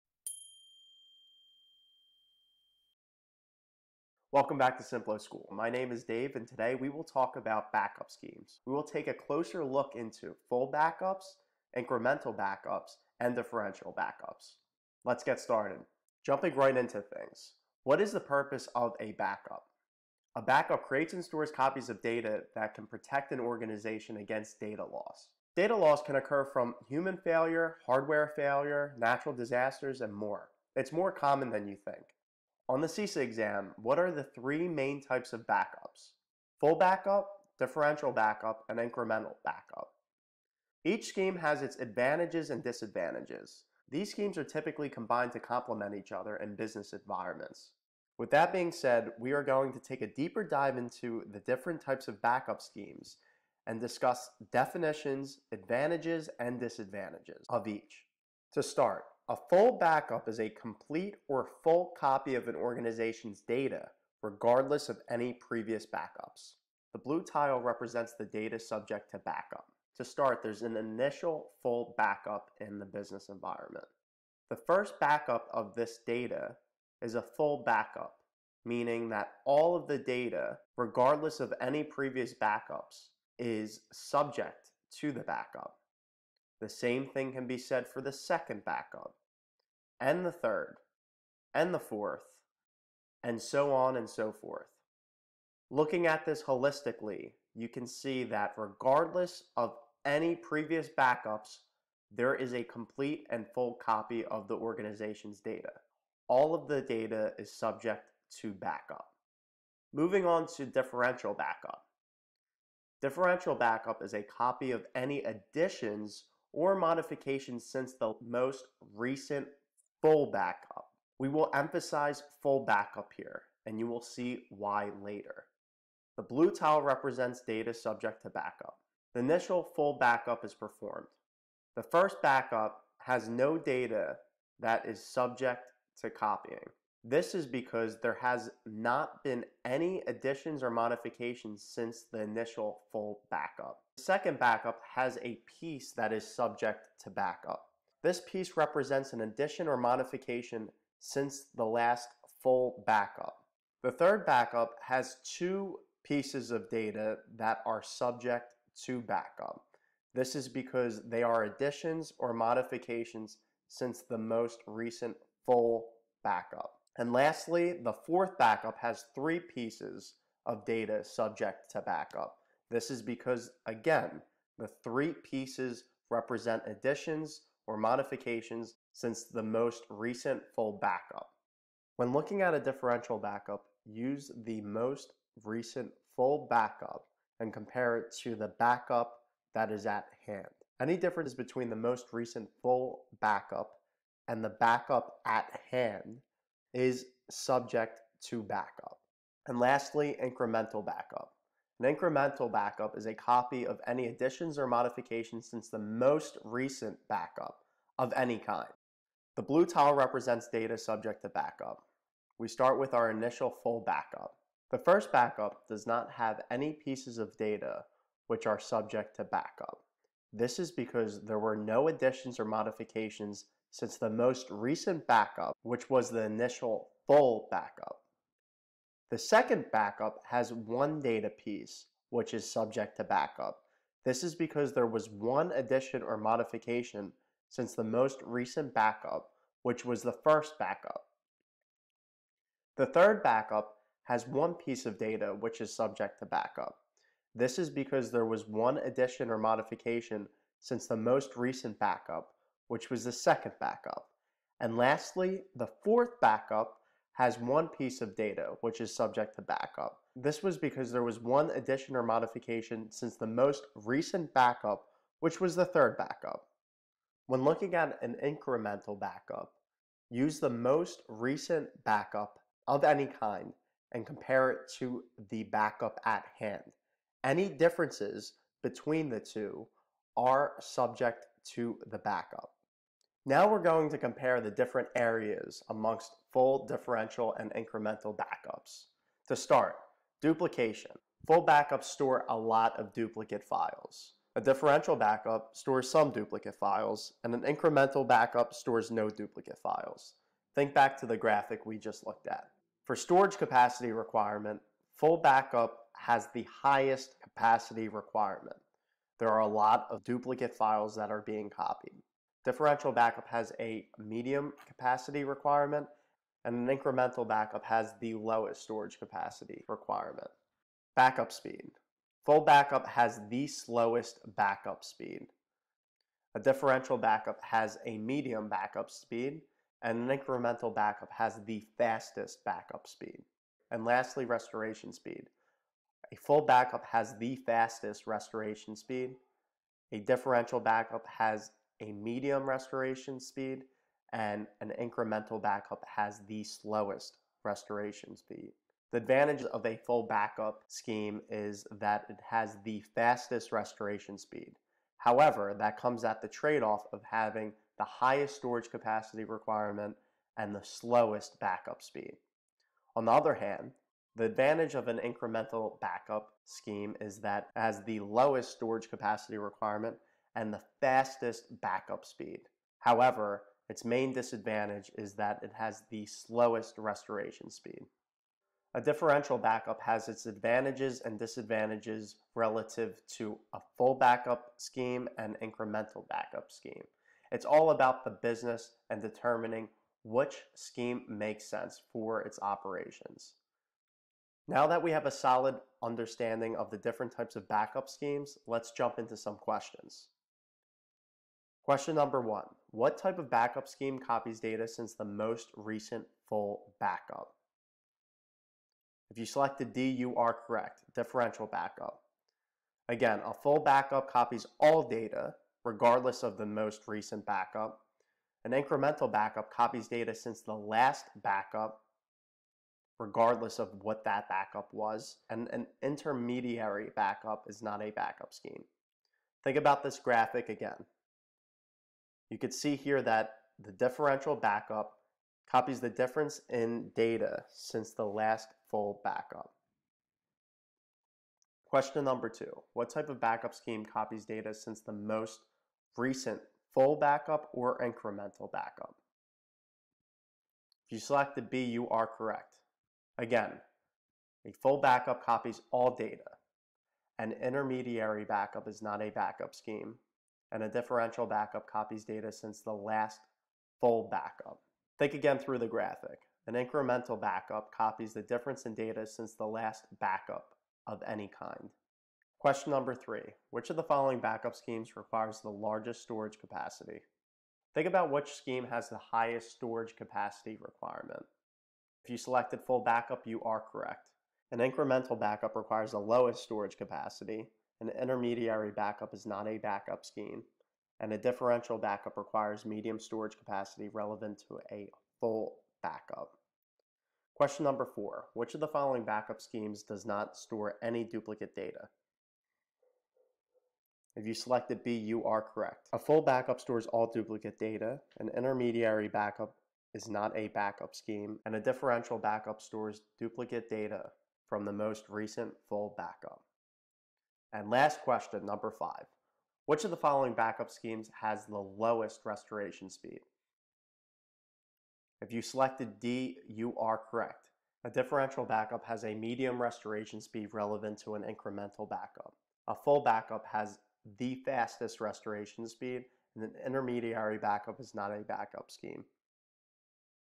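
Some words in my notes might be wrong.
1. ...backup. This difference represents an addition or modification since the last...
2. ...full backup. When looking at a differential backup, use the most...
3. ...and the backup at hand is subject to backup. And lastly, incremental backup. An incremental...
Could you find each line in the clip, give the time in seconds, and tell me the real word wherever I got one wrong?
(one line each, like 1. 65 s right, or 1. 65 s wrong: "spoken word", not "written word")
1. 147 s wrong: "piece", not "difference"
2. 180 s right
3. 194 s right.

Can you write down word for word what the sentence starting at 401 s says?
Question number one, what type of backup scheme copies data since the most recent full backup?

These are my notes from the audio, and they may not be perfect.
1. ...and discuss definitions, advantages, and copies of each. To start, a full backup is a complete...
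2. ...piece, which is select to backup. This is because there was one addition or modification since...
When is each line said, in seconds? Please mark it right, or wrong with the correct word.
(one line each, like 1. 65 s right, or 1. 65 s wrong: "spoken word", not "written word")
1. 53 s wrong: "disadvantages", not "copies"
2. 231 s wrong: "subject", not "select".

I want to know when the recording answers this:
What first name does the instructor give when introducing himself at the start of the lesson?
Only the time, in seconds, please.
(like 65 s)
6 s.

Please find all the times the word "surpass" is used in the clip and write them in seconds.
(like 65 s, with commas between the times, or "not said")
not said.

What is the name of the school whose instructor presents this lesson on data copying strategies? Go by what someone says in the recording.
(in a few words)
Simplo School.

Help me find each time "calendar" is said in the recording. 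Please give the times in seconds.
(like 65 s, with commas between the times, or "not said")
not said.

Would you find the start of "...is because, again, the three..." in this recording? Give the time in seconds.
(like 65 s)
172 s.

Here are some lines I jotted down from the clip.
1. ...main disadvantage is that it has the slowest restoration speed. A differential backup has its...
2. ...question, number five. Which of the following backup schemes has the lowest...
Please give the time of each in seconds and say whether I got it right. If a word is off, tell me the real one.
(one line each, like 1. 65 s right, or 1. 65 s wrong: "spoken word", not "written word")
1. 373 s right
2. 518 s right.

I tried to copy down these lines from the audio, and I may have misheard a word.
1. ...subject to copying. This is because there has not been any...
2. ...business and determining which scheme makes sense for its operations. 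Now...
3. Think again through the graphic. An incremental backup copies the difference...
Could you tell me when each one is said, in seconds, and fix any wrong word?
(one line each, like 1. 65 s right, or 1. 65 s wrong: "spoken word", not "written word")
1. 135 s right
2. 388 s right
3. 464 s right.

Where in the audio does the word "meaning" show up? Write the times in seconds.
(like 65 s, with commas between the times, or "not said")
78 s.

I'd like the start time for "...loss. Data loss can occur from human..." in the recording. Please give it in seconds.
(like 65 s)
24 s.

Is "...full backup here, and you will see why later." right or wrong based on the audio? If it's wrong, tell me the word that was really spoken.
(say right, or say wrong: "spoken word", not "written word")
right.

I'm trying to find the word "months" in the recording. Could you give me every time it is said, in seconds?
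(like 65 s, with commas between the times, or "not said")
not said.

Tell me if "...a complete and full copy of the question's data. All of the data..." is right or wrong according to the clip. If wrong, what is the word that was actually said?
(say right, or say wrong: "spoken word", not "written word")
wrong: "organization", not "question".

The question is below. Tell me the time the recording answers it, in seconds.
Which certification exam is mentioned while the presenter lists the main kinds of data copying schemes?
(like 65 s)
32 s.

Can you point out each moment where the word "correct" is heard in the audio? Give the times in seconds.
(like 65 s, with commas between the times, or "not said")
410 s, 452 s, 483 s, 505 s, 526 s.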